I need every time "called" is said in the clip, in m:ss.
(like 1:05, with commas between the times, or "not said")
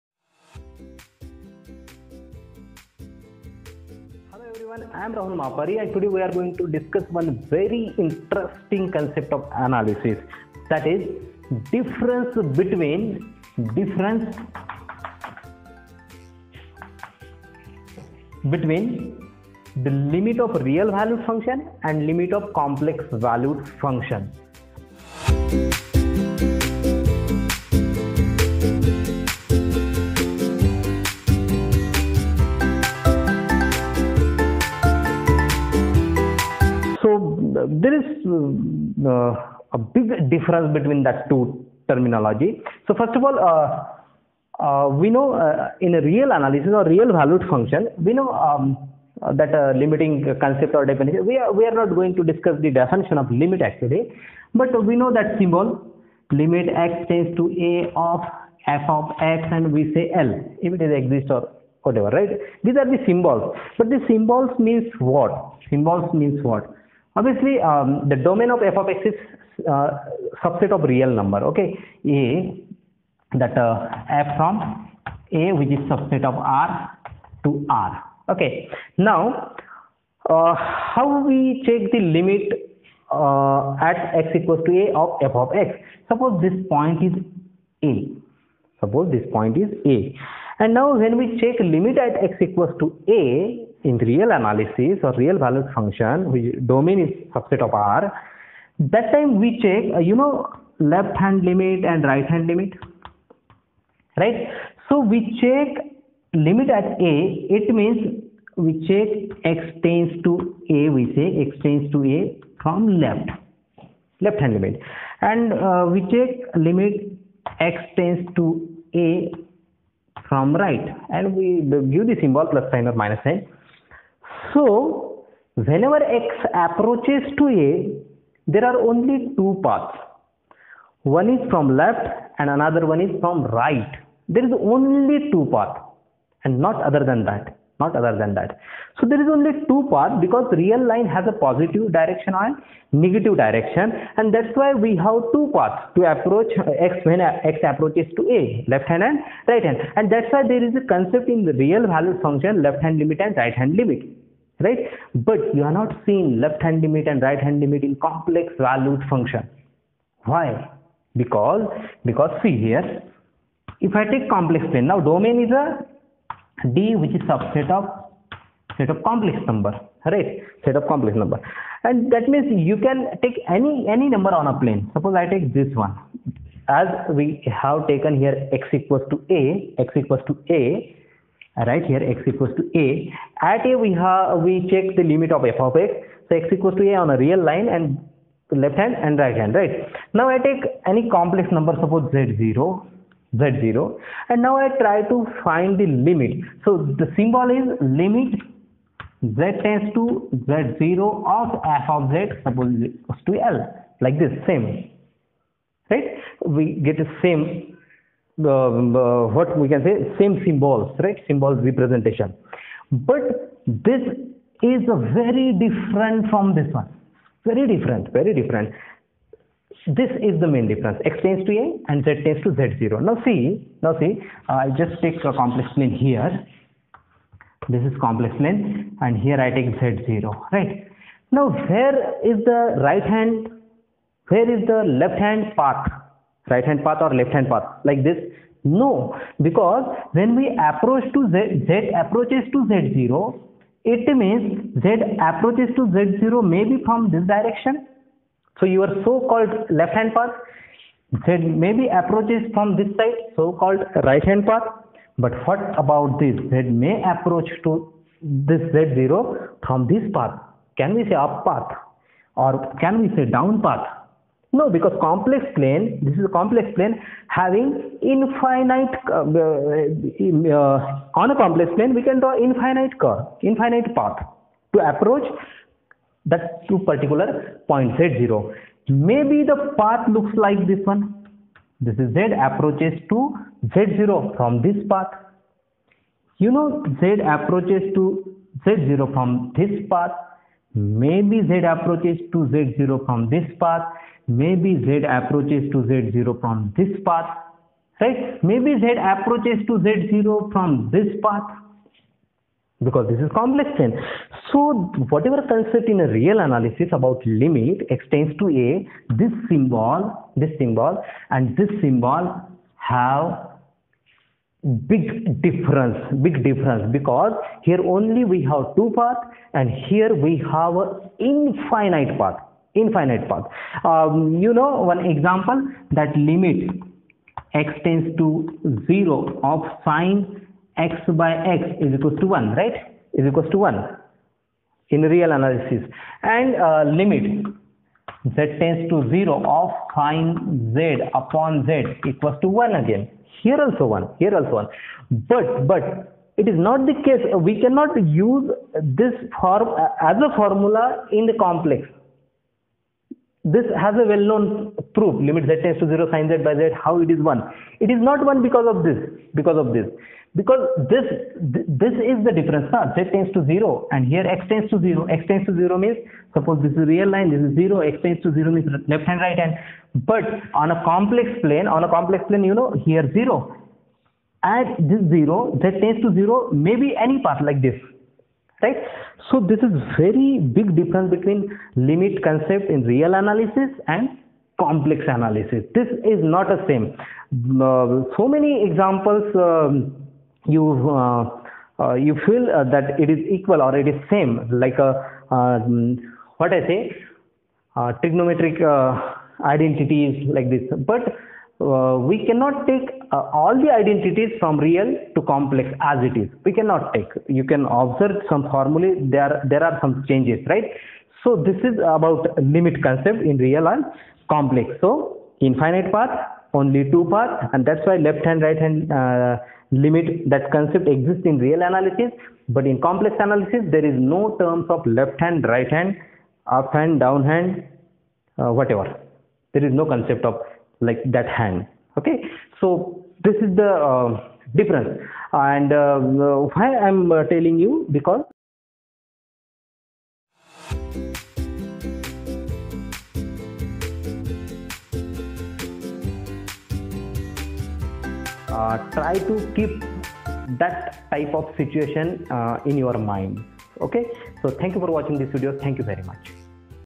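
4:09, 4:13.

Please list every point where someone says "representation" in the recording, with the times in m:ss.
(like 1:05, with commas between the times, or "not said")
3:31.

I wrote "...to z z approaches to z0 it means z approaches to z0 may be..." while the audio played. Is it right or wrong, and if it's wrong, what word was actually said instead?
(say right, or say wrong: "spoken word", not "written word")
right.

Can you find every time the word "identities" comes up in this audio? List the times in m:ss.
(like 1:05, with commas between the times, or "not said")
6:39, 6:43.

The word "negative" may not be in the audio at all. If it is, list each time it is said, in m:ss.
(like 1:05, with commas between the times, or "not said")
2:23.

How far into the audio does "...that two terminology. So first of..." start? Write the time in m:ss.
0:41.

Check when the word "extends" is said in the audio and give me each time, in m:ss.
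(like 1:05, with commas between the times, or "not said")
5:07.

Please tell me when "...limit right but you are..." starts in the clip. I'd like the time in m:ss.
2:33.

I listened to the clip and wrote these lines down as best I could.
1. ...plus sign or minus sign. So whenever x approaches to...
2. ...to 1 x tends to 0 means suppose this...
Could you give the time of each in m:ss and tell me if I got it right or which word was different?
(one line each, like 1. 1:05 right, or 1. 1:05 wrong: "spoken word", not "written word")
1. 2:02 right
2. 6:04 wrong: "0", not "1".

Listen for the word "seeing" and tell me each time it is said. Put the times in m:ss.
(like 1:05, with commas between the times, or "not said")
2:36.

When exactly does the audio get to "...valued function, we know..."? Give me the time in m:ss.
0:47.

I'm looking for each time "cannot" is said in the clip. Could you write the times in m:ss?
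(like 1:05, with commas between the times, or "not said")
5:47, 6:42, 6:46.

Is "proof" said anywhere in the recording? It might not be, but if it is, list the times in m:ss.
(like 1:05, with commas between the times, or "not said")
5:54.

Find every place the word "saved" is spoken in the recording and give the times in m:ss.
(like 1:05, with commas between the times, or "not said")
not said.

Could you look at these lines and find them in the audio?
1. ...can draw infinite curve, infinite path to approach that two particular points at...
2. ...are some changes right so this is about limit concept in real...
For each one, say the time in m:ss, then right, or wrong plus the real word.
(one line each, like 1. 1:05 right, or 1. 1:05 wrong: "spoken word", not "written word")
1. 4:32 right
2. 6:49 right.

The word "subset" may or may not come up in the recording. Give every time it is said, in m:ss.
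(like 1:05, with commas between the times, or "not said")
1:10, 1:15, 1:37, 2:47.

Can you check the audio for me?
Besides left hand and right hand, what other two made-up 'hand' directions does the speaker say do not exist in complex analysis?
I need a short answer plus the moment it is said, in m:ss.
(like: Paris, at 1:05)
up hand, down hand, at 7:06.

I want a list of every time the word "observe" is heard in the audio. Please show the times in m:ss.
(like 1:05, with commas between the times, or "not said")
6:47.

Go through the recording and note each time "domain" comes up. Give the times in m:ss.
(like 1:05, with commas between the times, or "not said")
1:08, 1:36, 2:45.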